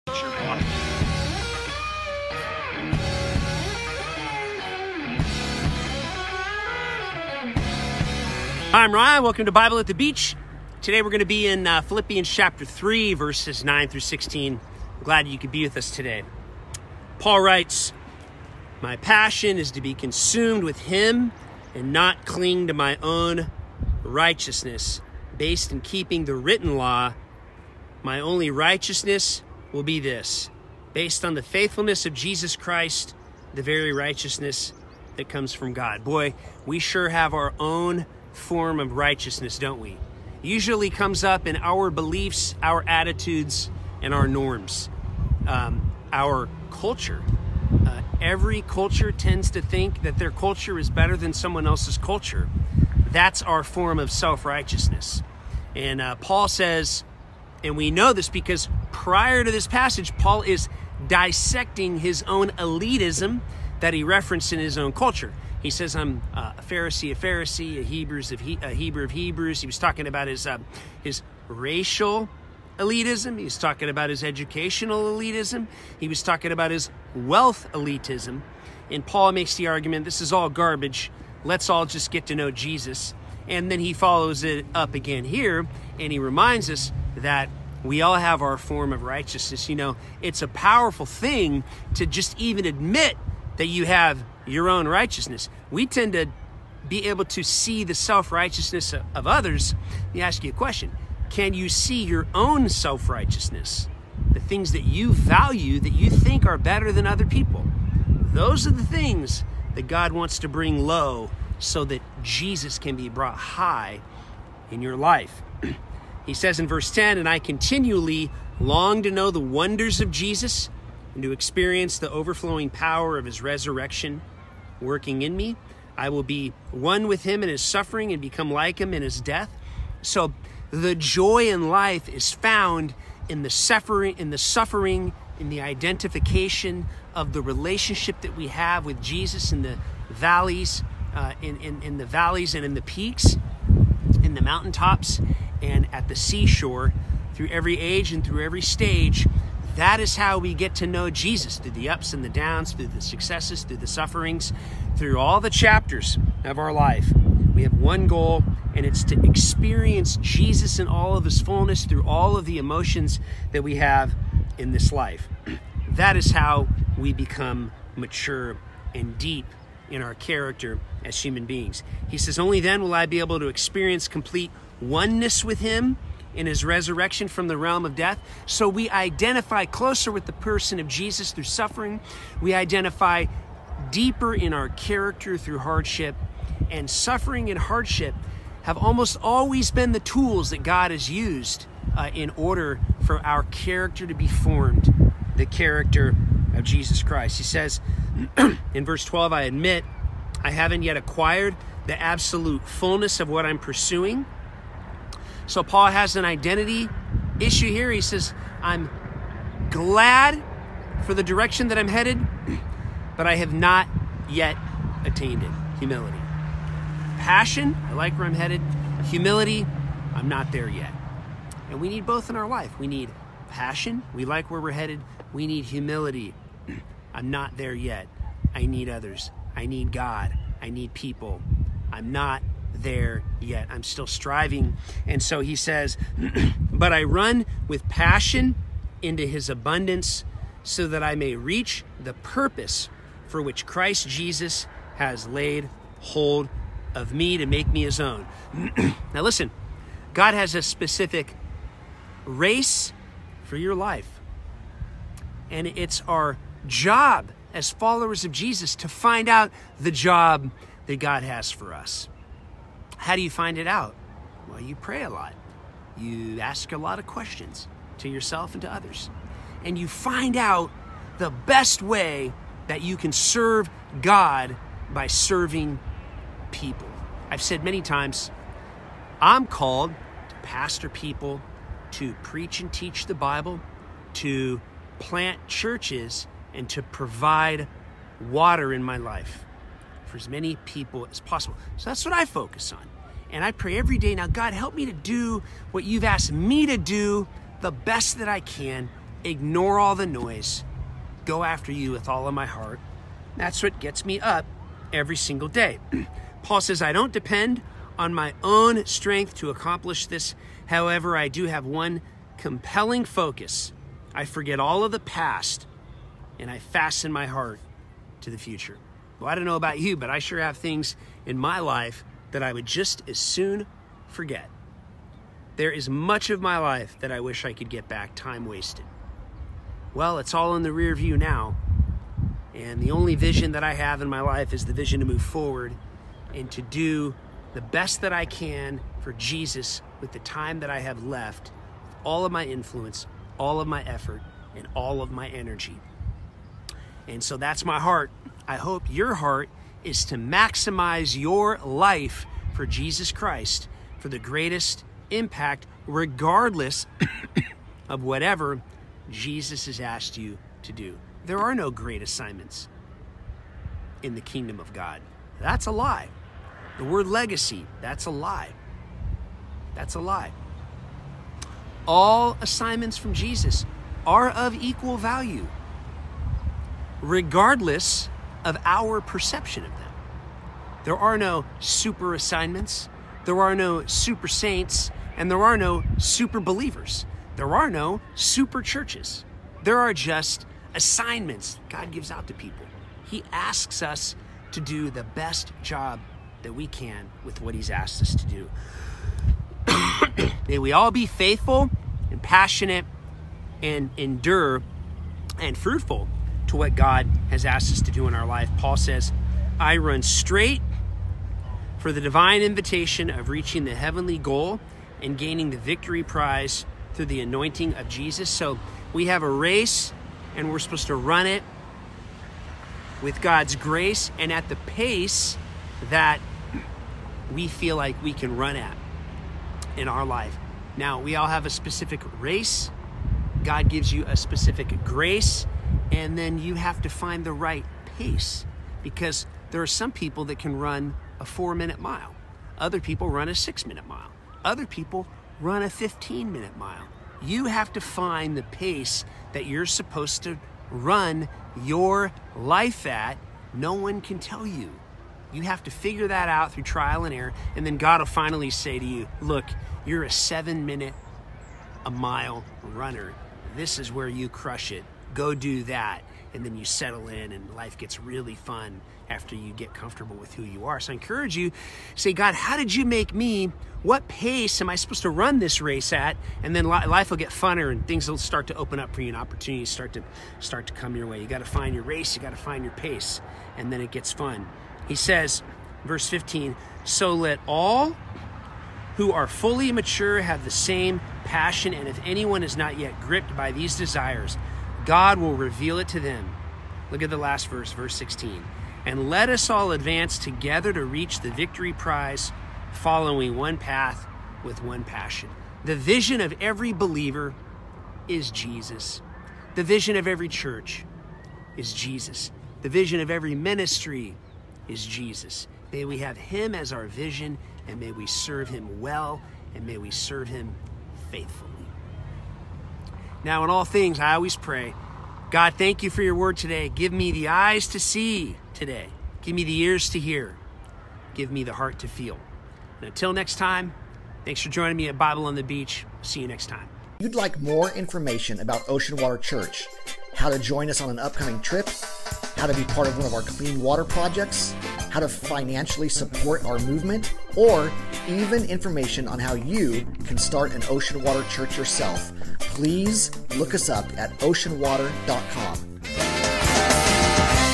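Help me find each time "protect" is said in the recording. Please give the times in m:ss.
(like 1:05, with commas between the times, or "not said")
not said.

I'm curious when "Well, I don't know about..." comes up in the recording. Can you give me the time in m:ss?
5:19.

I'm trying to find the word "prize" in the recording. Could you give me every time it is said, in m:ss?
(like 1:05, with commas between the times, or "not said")
6:56, 8:21.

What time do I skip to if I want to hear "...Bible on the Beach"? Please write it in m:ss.
8:54.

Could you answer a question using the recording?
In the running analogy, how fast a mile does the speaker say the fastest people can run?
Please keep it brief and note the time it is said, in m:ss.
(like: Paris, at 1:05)
4 minutes, at 7:21.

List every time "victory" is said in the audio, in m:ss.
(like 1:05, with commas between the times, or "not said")
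6:55, 8:21.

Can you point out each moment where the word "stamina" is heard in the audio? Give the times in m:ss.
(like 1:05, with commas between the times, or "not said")
not said.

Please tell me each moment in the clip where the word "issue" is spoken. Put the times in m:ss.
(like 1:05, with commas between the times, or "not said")
3:27.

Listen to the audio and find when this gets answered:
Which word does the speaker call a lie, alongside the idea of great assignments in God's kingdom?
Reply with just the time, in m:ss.
6:07.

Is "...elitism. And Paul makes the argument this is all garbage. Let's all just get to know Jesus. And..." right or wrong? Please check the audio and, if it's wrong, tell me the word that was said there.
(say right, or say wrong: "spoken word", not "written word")
right.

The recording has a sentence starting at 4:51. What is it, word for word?
So that's what I focus on.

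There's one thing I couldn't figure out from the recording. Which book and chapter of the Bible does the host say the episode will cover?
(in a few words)
Philippians chapter 3.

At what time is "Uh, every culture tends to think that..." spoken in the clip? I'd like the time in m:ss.
0:47.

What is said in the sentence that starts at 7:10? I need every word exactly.
Now, we all have a specific race.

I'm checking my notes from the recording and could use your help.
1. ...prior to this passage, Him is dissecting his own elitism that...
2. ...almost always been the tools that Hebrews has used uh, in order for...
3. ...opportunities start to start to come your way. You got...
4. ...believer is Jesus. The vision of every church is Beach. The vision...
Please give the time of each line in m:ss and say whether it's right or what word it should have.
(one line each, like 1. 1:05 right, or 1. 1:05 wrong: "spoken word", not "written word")
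1. 0:58 wrong: "Paul", not "Him"
2. 3:08 wrong: "God", not "Hebrews"
3. 7:59 right
4. 8:26 wrong: "Jesus", not "Beach".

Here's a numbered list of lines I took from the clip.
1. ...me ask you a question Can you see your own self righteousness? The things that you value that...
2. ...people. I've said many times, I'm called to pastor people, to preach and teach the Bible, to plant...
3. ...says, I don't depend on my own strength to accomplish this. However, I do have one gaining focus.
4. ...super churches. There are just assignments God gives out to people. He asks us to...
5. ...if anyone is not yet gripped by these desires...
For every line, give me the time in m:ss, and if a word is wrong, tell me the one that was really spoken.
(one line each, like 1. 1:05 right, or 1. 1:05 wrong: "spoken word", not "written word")
1. 1:40 right
2. 4:36 right
3. 5:06 wrong: "compelling", not "gaining"
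4. 6:28 right
5. 8:11 right.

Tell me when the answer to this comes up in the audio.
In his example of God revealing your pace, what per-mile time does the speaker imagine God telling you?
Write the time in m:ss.
7:40.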